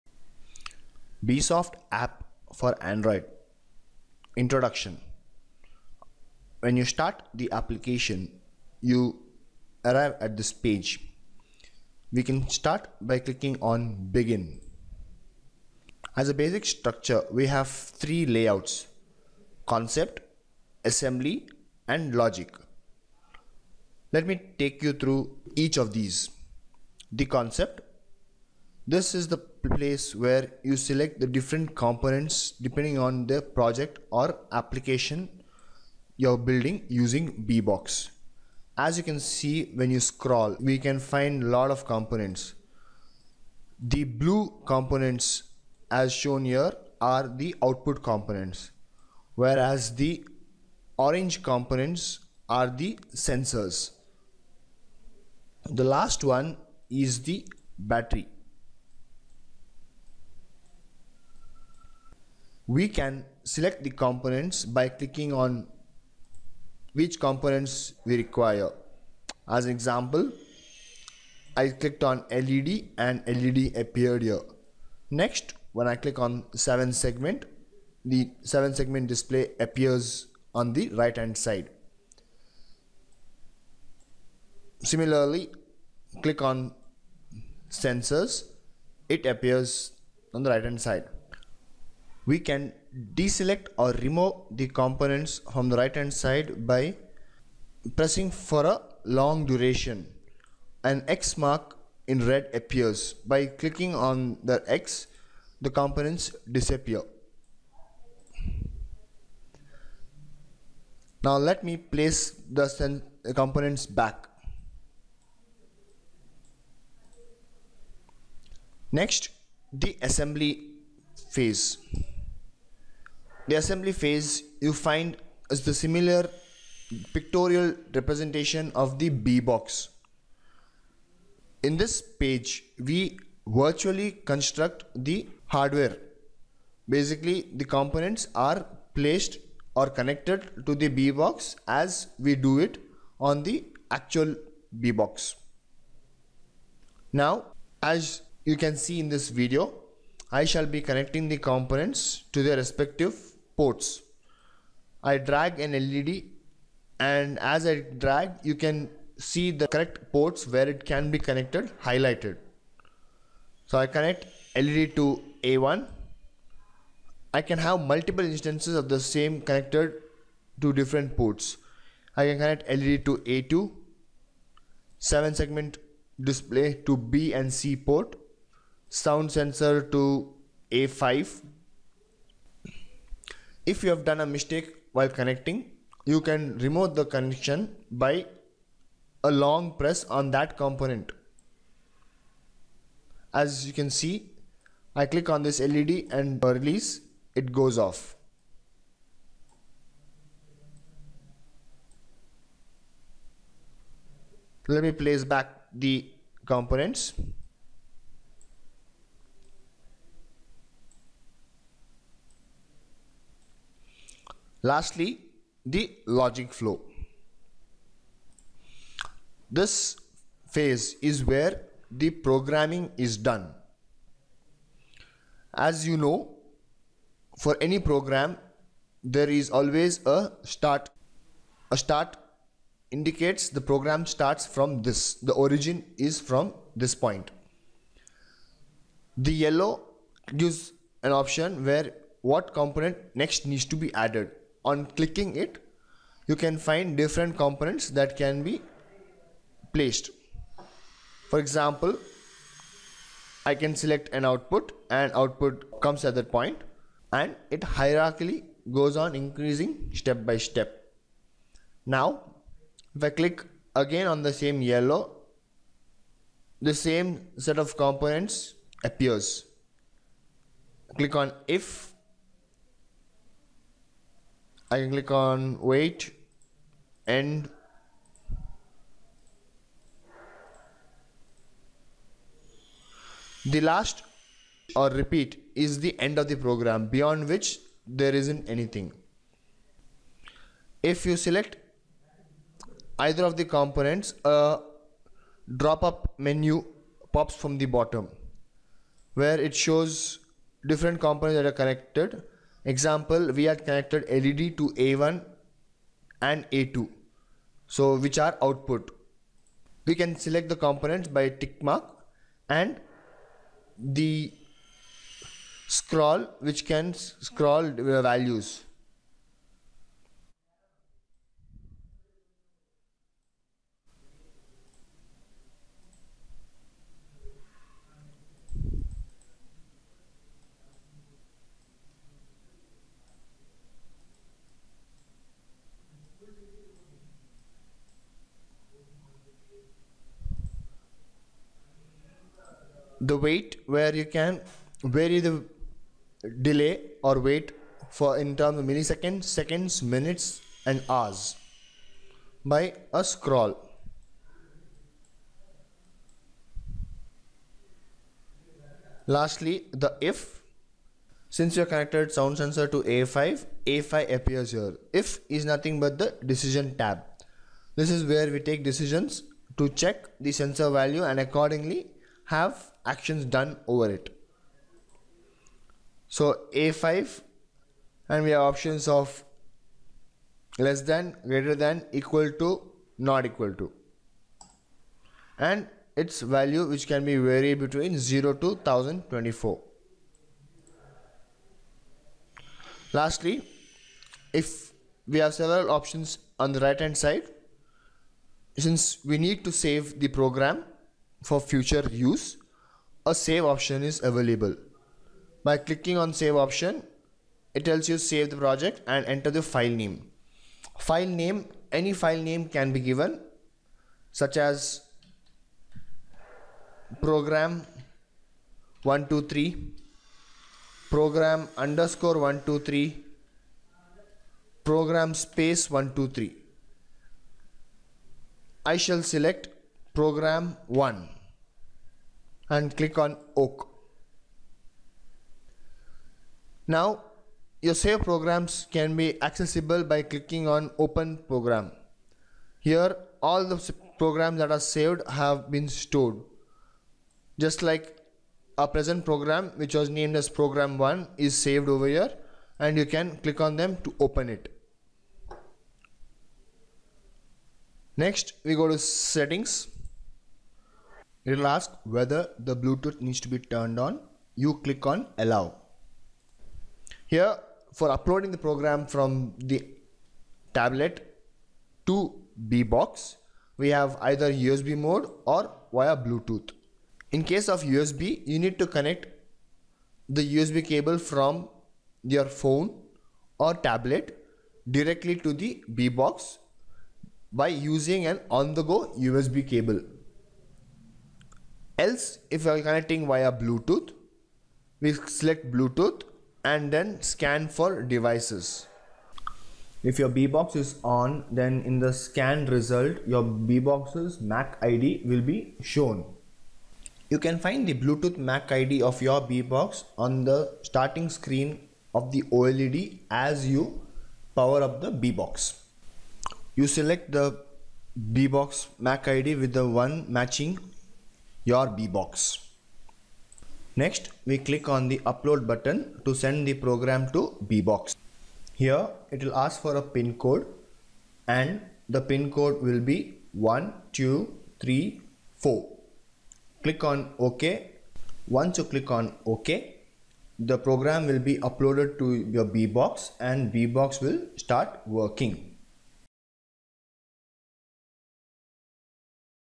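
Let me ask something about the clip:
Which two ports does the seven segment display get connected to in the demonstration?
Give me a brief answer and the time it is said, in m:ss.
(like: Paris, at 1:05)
B and C, at 2:56.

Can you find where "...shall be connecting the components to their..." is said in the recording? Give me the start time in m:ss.
2:30.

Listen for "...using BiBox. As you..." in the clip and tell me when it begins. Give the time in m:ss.
0:36.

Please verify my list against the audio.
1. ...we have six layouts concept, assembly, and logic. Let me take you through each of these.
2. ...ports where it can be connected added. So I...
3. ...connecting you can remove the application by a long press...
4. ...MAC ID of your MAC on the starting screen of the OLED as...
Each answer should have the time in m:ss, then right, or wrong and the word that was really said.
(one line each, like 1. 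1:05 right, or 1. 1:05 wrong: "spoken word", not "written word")
1. 0:17 wrong: "three", not "six"
2. 2:40 wrong: "highlighted", not "added"
3. 3:05 wrong: "connection", not "application"
4. 8:28 wrong: "BiBox", not "MAC".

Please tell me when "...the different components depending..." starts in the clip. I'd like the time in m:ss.
0:31.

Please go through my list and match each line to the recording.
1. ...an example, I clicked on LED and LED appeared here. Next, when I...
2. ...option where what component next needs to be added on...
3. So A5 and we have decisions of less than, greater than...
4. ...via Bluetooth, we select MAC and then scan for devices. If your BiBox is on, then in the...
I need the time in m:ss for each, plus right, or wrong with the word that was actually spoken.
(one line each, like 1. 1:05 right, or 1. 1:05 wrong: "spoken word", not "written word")
1. 1:09 right
2. 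4:01 right
3. 6:16 wrong: "options", not "decisions"
4. 8:13 wrong: "Bluetooth", not "MAC".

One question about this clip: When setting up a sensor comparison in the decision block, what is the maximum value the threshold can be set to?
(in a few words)
1024.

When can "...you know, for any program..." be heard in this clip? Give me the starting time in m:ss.
3:45.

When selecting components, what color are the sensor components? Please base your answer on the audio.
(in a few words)
Orange.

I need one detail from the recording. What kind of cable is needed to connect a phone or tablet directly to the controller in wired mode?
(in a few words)
On-the-go USB cable.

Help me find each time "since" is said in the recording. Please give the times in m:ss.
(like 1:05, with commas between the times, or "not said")
6:01, 6:38.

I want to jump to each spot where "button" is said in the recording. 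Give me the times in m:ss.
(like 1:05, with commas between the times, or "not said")
8:45.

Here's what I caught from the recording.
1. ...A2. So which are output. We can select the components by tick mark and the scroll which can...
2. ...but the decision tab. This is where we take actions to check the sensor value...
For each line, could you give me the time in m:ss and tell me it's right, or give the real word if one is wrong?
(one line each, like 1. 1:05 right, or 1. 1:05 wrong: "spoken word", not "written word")
1. 5:06 right
2. 6:05 wrong: "decisions", not "actions".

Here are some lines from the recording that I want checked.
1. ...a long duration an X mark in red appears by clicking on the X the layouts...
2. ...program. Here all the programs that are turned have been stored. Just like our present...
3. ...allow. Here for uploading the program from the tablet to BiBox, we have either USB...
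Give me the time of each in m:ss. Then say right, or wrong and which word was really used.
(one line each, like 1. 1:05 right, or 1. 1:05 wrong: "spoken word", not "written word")
1. 1:38 wrong: "components", not "layouts"
2. 7:21 wrong: "saved", not "turned"
3. 7:45 right.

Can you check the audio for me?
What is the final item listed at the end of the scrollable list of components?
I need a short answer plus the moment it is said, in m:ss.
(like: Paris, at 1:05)
Battery, at 0:57.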